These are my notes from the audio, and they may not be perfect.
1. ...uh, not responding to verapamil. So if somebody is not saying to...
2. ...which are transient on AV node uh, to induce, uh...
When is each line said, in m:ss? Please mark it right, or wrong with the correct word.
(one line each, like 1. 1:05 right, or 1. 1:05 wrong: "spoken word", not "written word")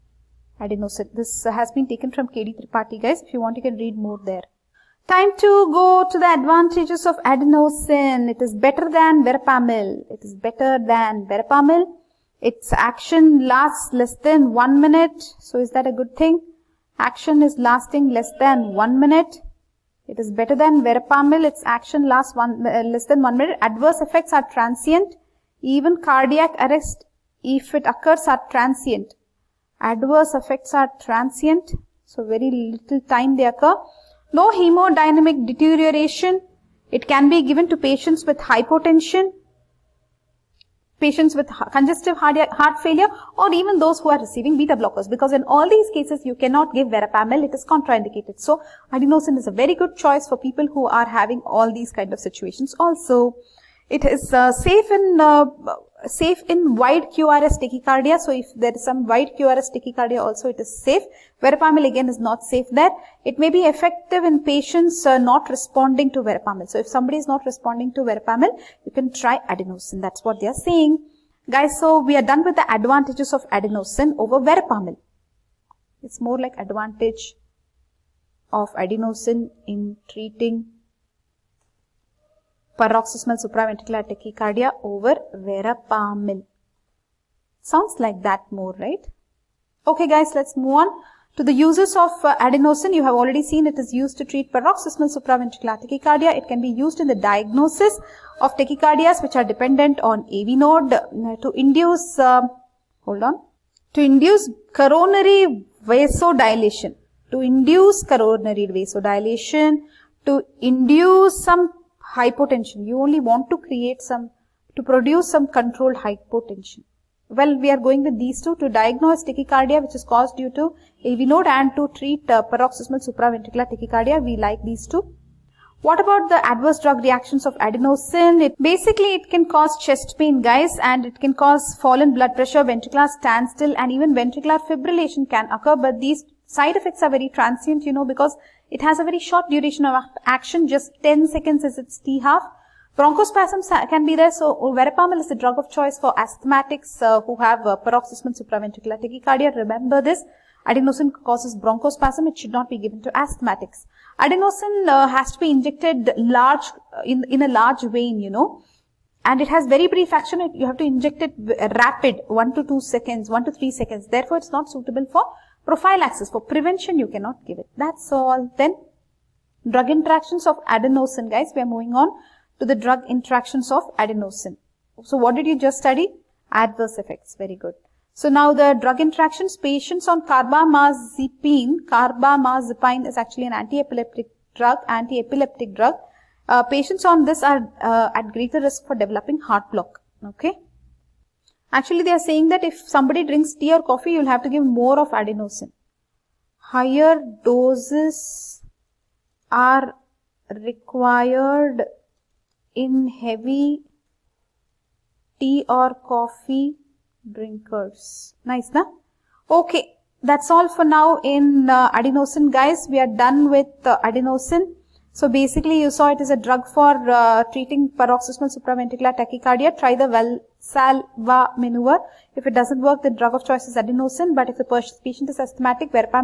1. 1:05 wrong: "responding", not "saying"
2. 1:39 wrong: "dependent", not "transient".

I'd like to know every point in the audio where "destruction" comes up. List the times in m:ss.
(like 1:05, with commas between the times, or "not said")
not said.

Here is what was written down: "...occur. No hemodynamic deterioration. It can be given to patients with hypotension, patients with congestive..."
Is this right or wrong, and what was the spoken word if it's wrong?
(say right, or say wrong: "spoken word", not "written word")
right.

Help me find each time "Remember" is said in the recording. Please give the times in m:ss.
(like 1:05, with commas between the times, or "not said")
2:29.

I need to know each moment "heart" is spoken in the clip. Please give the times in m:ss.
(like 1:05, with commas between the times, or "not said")
0:42, 3:09.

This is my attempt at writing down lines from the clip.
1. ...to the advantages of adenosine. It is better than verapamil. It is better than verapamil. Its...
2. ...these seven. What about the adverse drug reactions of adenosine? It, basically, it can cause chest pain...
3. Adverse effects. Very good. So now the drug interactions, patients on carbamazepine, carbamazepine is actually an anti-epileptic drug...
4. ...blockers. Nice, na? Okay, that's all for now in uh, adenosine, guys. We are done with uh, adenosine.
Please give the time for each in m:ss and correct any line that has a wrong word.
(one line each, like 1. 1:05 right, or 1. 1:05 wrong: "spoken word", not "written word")
1. 0:06 right
2. 2:04 wrong: "two", not "seven"
3. 2:56 right
4. 3:27 wrong: "drinkers", not "blockers".